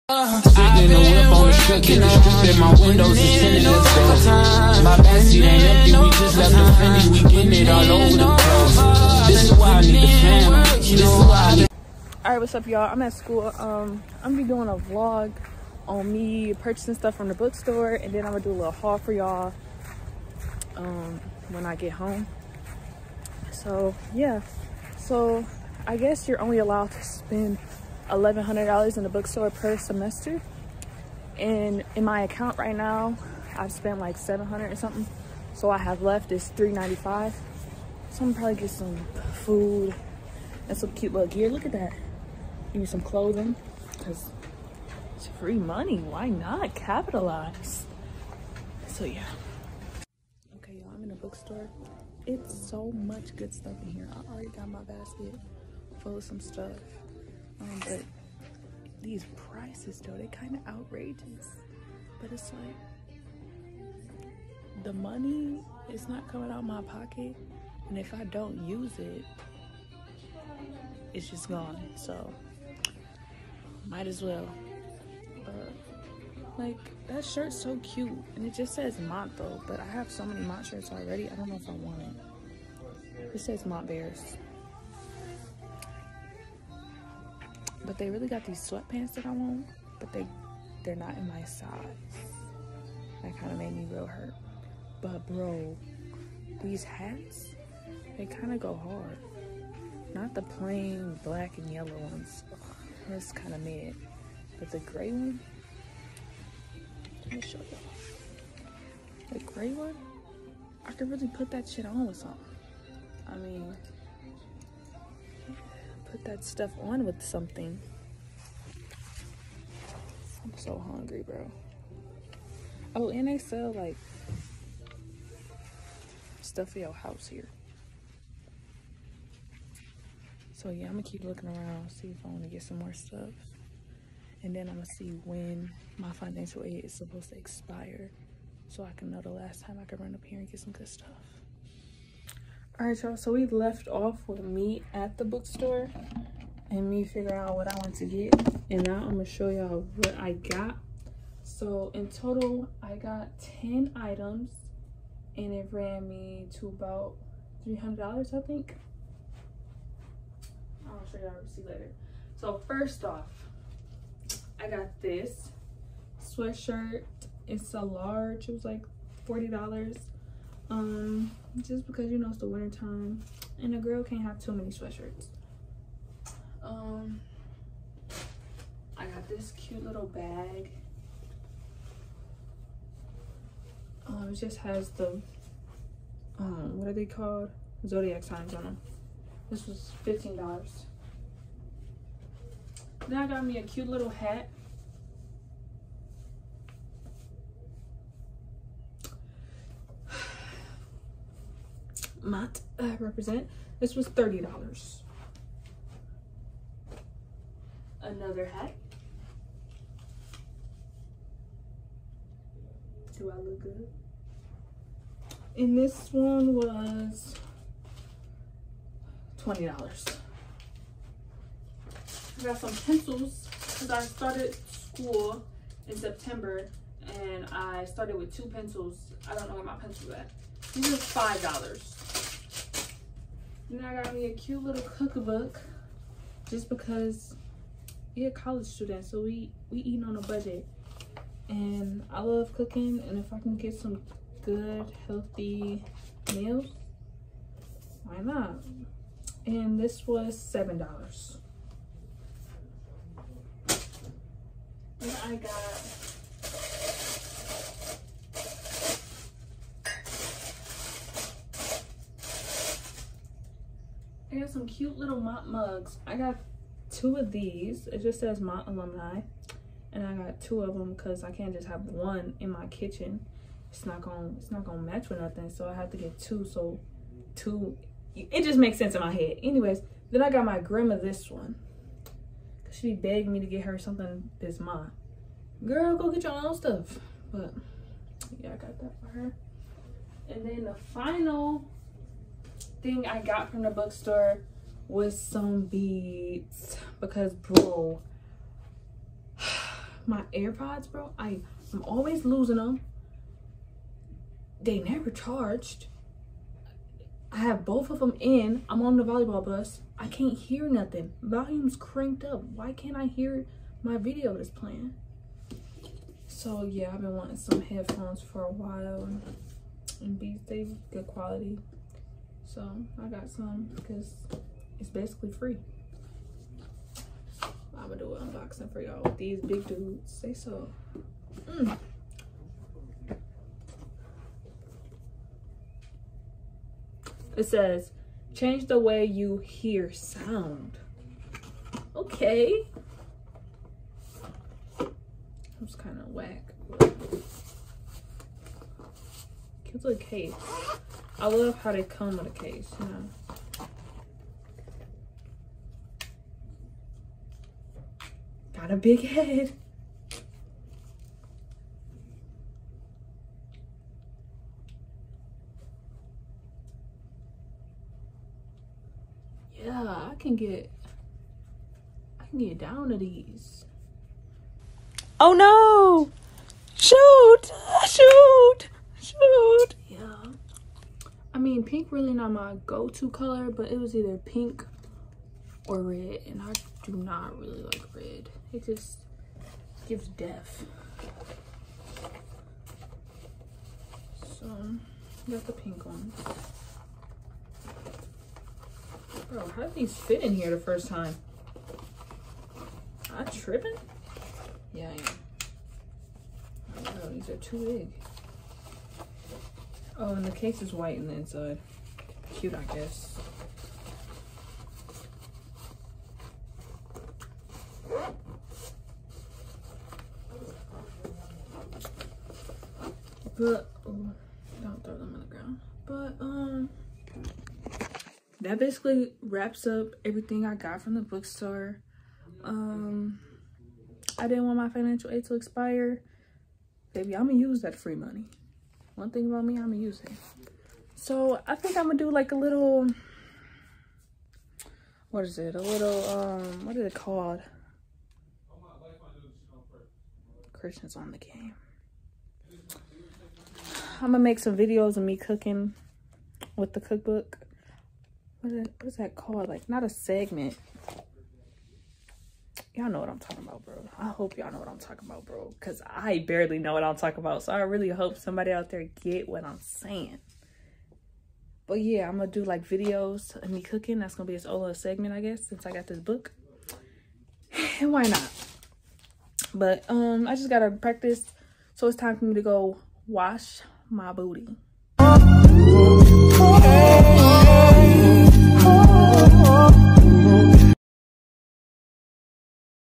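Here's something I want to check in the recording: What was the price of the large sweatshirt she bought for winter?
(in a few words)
$40.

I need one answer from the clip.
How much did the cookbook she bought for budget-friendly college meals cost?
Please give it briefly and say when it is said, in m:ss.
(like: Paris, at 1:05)
$7, at 4:10.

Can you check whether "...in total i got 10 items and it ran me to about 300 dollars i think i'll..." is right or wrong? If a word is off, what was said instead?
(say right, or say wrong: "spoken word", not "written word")
right.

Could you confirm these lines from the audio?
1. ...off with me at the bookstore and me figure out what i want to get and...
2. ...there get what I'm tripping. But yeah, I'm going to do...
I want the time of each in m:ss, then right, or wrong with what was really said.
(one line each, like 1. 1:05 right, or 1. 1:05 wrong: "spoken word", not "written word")
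1. 2:23 right
2. 7:48 wrong: "saying", not "tripping".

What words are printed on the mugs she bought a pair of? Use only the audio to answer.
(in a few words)
Mott alumni.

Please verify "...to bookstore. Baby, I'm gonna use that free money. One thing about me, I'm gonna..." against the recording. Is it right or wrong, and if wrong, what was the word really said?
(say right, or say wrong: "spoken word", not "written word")
wrong: "expire", not "bookstore".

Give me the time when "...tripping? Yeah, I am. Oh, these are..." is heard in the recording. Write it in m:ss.
6:43.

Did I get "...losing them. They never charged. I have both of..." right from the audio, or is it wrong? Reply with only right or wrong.
right.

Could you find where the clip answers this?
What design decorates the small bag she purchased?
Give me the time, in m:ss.
3:07.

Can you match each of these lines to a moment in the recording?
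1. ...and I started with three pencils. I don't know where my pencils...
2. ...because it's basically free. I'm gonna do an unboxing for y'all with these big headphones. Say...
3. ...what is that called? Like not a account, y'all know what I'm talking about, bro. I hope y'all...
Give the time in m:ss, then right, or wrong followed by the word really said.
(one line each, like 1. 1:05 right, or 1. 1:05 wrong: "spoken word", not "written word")
1. 3:47 wrong: "two", not "three"
2. 5:23 wrong: "dudes", not "headphones"
3. 7:38 wrong: "segment", not "account".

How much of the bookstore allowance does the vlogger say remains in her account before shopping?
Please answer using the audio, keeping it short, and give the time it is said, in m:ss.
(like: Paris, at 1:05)
395, at 0:36.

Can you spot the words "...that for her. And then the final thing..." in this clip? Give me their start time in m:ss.
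4:48.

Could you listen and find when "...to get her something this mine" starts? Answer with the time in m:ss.
4:43.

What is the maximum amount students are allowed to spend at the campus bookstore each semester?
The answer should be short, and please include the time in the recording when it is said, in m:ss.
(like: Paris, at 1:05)
$1,100, at 0:28.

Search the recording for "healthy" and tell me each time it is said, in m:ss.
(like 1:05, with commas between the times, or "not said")
4:05.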